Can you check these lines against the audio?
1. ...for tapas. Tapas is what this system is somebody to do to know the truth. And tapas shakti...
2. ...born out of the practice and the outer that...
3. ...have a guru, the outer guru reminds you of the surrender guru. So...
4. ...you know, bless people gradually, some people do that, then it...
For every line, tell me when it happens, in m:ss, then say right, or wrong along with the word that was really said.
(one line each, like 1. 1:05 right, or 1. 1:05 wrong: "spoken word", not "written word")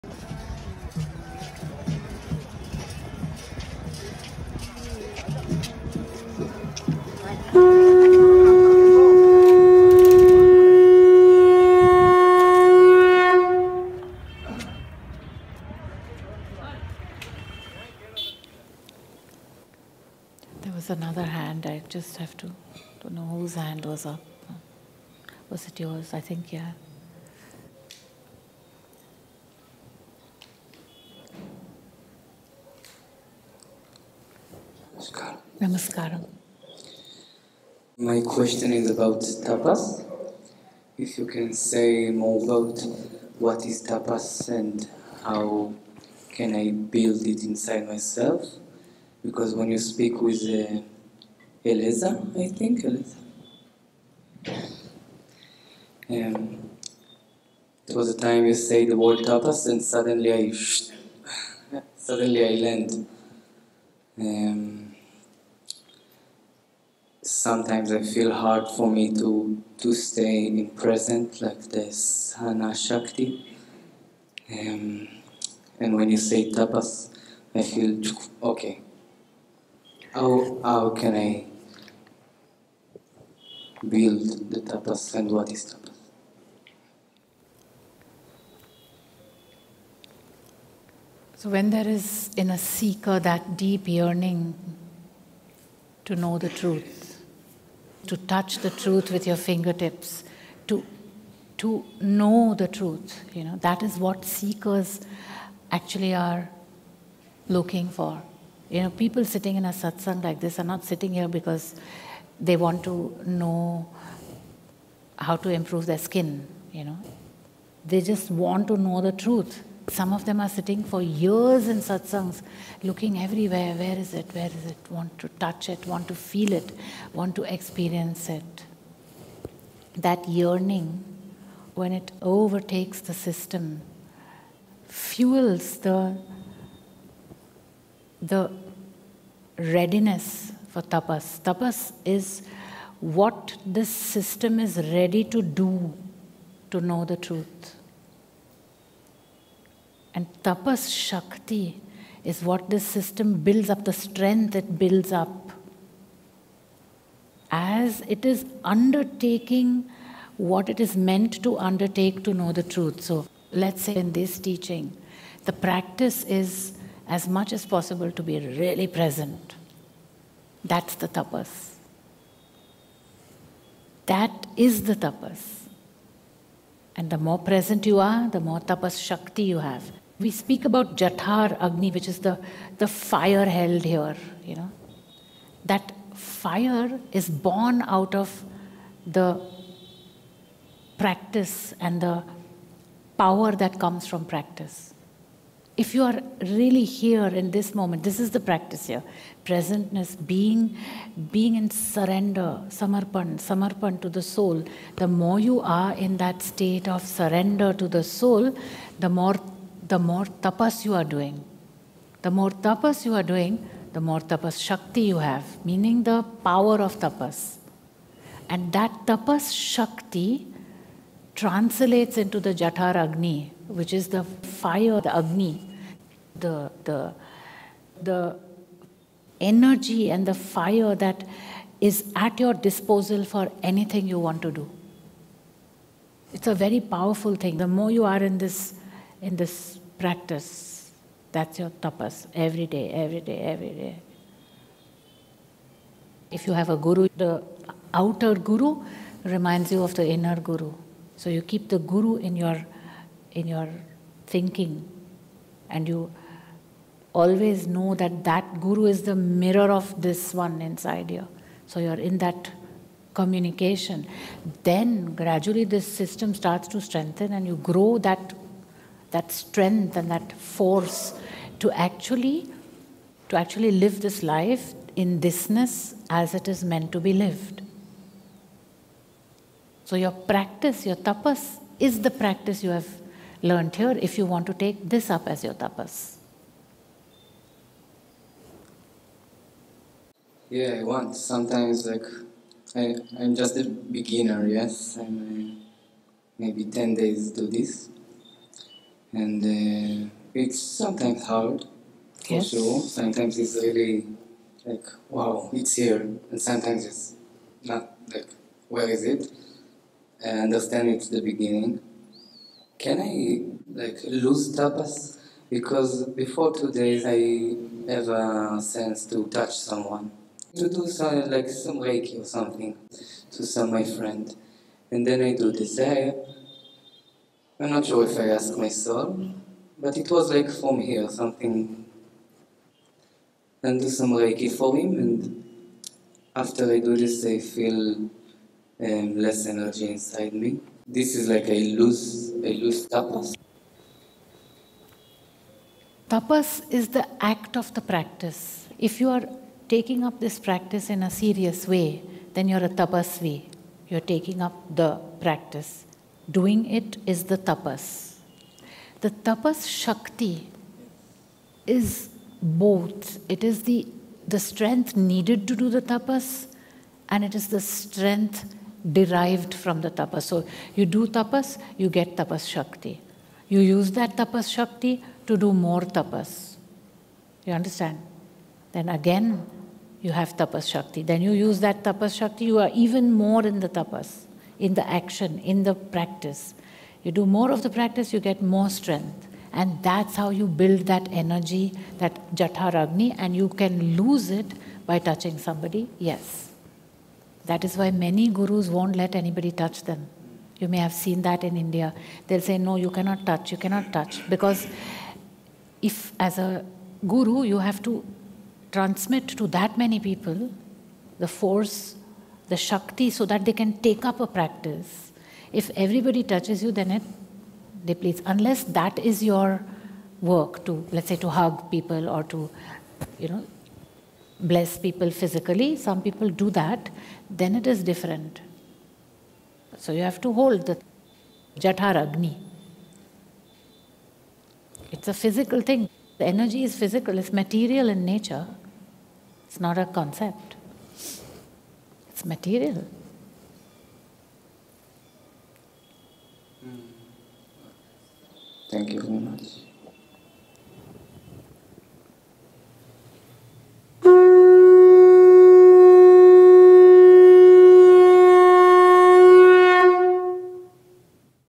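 1. 2:20 wrong: "ready", not "somebody"
2. 3:07 wrong: "power", not "outer"
3. 4:06 wrong: "inner", not "surrender"
4. 7:03 wrong: "physically", not "gradually".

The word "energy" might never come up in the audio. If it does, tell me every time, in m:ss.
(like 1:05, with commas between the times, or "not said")
3:49, 5:39, 6:31, 7:16.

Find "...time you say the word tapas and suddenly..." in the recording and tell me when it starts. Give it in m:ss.
0:58.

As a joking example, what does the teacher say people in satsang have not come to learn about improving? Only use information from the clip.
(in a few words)
their skin.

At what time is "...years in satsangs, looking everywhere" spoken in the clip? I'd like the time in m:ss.
2:01.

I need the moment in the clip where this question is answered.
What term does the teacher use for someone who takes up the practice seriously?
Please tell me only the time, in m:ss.
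5:52.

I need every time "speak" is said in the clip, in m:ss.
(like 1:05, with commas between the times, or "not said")
0:49, 3:00.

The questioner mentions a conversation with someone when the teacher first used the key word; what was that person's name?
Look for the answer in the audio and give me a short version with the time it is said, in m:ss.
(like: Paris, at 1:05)
Eliza, at 0:52.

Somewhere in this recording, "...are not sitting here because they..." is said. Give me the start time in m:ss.
1:50.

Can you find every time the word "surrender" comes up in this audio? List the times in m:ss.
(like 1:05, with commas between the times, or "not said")
3:21, 3:27.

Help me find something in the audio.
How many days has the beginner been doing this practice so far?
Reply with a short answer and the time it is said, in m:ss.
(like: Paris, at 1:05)
10 days, at 4:56.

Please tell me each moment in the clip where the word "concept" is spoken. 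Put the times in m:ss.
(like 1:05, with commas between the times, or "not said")
7:19.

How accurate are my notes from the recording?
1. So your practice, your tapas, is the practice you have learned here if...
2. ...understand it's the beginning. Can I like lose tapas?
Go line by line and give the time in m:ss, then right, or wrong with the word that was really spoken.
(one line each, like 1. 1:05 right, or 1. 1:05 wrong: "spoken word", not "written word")
1. 4:39 right
2. 5:10 right.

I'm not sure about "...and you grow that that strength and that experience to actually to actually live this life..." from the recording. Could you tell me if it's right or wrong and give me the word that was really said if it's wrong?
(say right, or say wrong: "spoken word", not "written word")
wrong: "force", not "experience".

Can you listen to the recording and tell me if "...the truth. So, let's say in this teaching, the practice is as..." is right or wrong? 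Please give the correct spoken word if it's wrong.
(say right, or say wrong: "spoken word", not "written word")
right.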